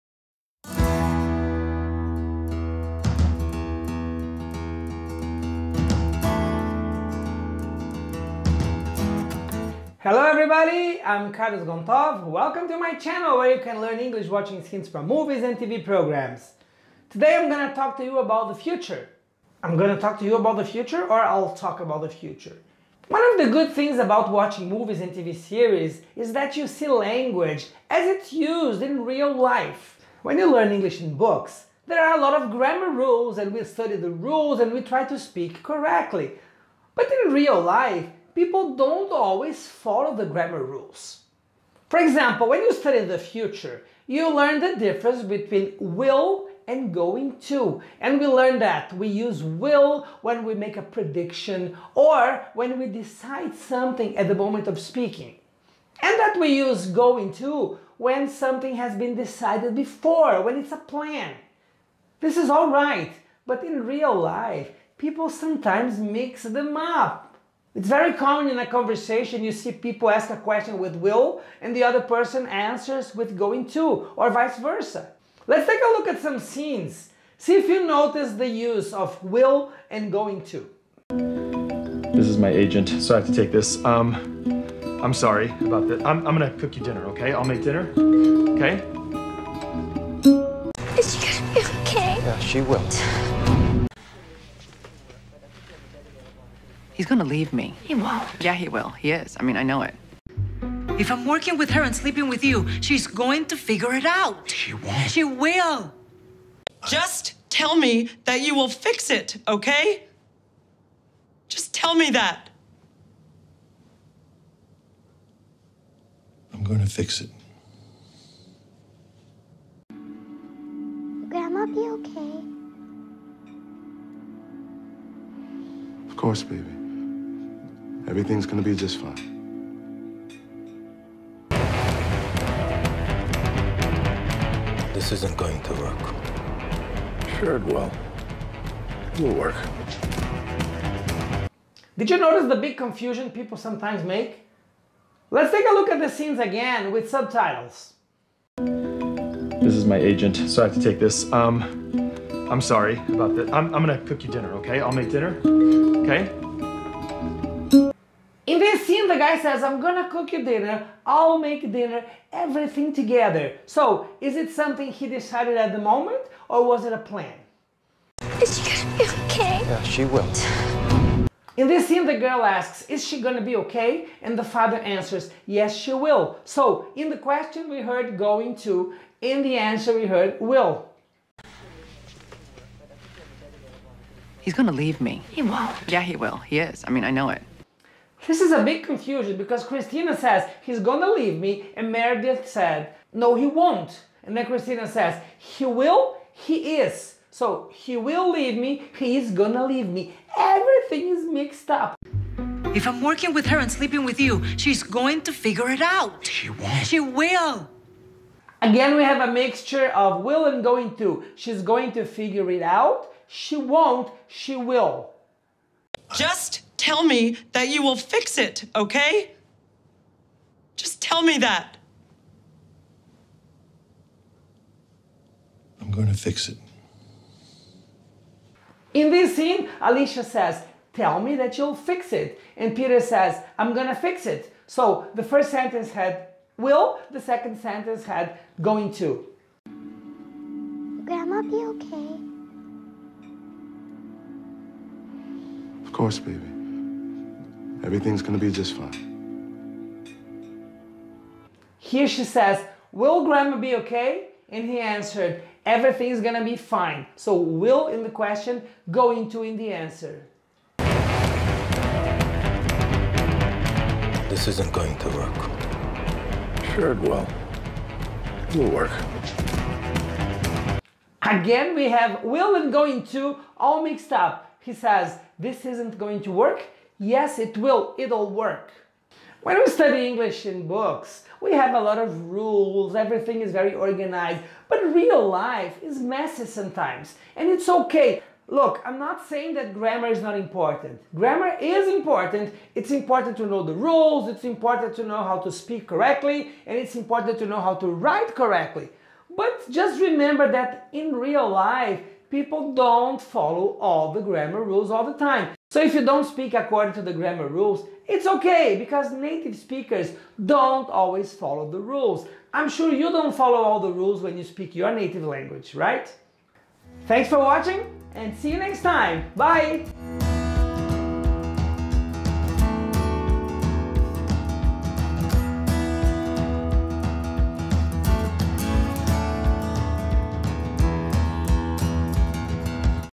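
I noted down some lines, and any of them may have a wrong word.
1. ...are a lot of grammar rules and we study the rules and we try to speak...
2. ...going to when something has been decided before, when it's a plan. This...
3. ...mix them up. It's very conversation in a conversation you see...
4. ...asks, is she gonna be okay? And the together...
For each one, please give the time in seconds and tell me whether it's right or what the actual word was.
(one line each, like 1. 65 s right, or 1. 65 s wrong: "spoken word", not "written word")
1. 32 s right
2. 56 s right
3. 65 s wrong: "common", not "conversation"
4. 172 s wrong: "father", not "together".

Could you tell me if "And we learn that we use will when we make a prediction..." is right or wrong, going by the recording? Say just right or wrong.
right.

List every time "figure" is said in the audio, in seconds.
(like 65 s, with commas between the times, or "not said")
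103 s, 205 s, 212 s.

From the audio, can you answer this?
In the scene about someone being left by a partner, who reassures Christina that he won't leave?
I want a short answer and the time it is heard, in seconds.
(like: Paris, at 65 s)
Meredith, at 191 s.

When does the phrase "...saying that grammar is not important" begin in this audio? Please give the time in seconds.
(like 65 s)
289 s.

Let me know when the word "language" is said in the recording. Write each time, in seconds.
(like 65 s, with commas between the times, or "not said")
26 s, 315 s.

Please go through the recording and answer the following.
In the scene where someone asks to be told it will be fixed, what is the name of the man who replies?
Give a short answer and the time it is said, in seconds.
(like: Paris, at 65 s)
Peter, at 232 s.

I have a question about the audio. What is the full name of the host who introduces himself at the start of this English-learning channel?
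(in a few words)
Carlos Gontow.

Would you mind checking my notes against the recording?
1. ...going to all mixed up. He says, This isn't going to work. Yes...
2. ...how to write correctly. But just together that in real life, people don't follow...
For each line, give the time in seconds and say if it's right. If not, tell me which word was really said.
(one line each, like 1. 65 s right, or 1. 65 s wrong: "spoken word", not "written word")
1. 272 s right
2. 297 s wrong: "remember", not "together".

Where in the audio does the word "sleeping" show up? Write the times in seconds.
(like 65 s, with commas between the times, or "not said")
101 s, 203 s.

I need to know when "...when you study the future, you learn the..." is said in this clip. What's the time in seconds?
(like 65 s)
42 s.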